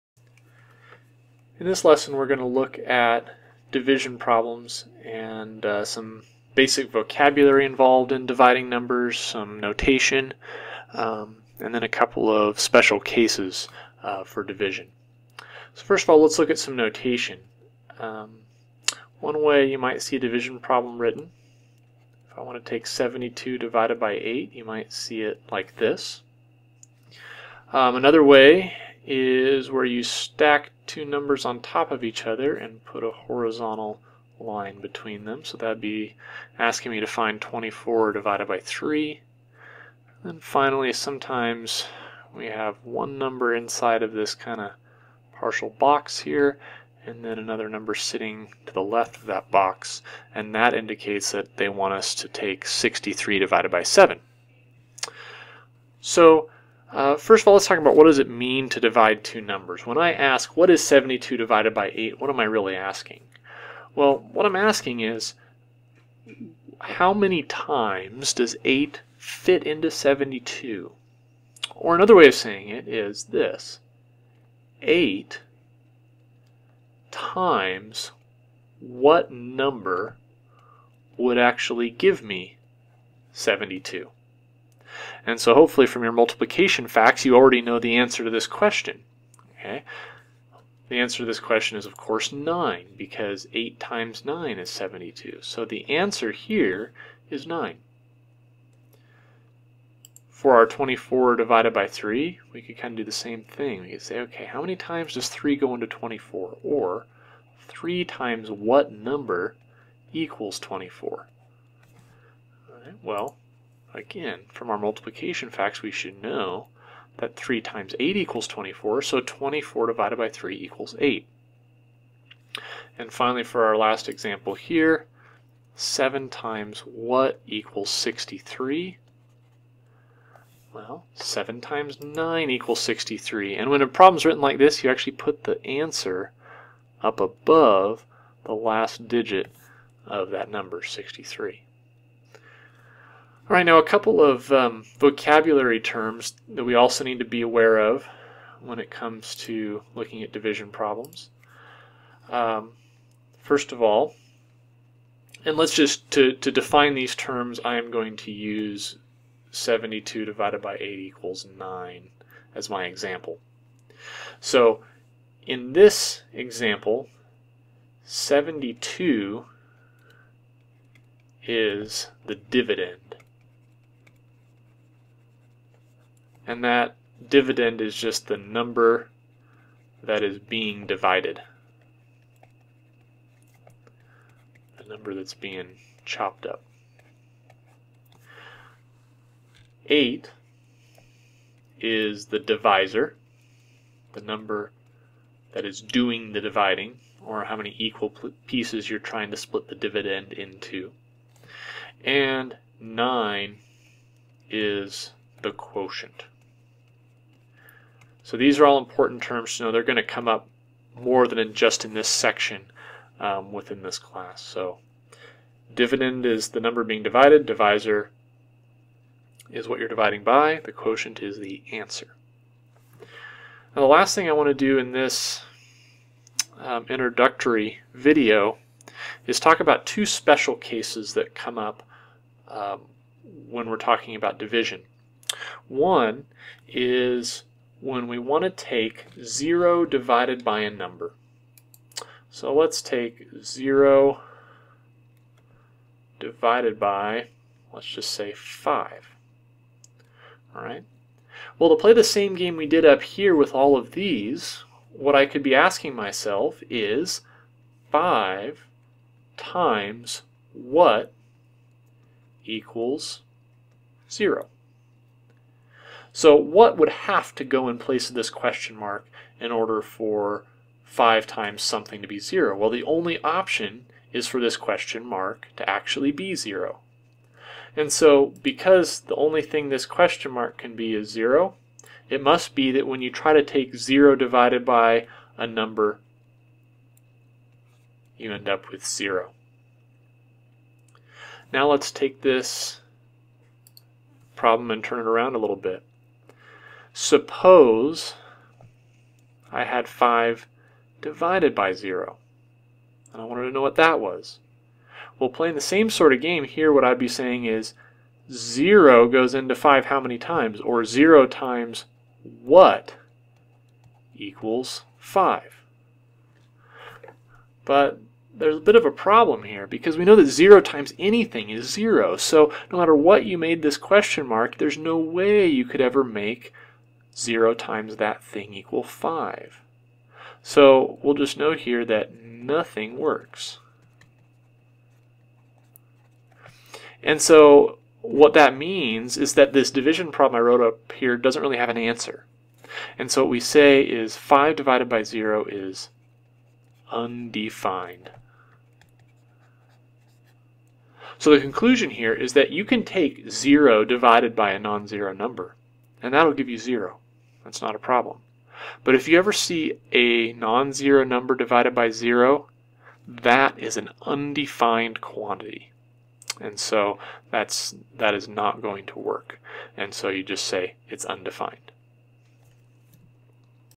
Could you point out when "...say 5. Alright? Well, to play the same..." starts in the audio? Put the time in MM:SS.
04:08.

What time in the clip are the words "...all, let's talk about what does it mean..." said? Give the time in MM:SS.
00:57.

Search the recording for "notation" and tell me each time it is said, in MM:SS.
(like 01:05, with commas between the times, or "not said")
00:09, 00:16.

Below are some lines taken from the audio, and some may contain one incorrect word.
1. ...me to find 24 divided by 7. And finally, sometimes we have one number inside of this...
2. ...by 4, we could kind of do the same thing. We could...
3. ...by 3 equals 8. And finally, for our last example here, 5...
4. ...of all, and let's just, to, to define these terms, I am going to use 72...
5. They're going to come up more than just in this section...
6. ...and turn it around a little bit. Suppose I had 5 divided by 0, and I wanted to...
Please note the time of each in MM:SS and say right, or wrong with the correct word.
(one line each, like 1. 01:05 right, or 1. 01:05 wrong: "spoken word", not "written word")
1. 00:36 wrong: "3", not "7"
2. 01:41 wrong: "3", not "4"
3. 02:00 wrong: "7", not "5"
4. 02:33 right
5. 03:29 right
6. 04:54 right.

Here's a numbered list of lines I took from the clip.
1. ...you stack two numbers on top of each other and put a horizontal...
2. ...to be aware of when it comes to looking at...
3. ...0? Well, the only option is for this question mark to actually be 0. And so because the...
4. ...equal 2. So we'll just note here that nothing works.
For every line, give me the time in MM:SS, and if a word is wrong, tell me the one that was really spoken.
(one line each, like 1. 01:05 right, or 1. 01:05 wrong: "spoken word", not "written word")
1. 00:29 right
2. 02:27 right
3. 04:32 right
4. 05:28 wrong: "5", not "2".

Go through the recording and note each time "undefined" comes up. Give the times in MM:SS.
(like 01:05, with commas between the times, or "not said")
05:46, 06:04, 06:11.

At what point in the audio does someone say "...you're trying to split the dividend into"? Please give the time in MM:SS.
03:18.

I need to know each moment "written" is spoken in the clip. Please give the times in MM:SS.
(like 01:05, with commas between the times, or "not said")
00:20, 02:14.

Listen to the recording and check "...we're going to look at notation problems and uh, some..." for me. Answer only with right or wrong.
wrong.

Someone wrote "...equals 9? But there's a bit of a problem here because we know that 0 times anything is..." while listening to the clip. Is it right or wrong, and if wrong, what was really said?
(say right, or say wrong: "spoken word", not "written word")
wrong: "5", not "9".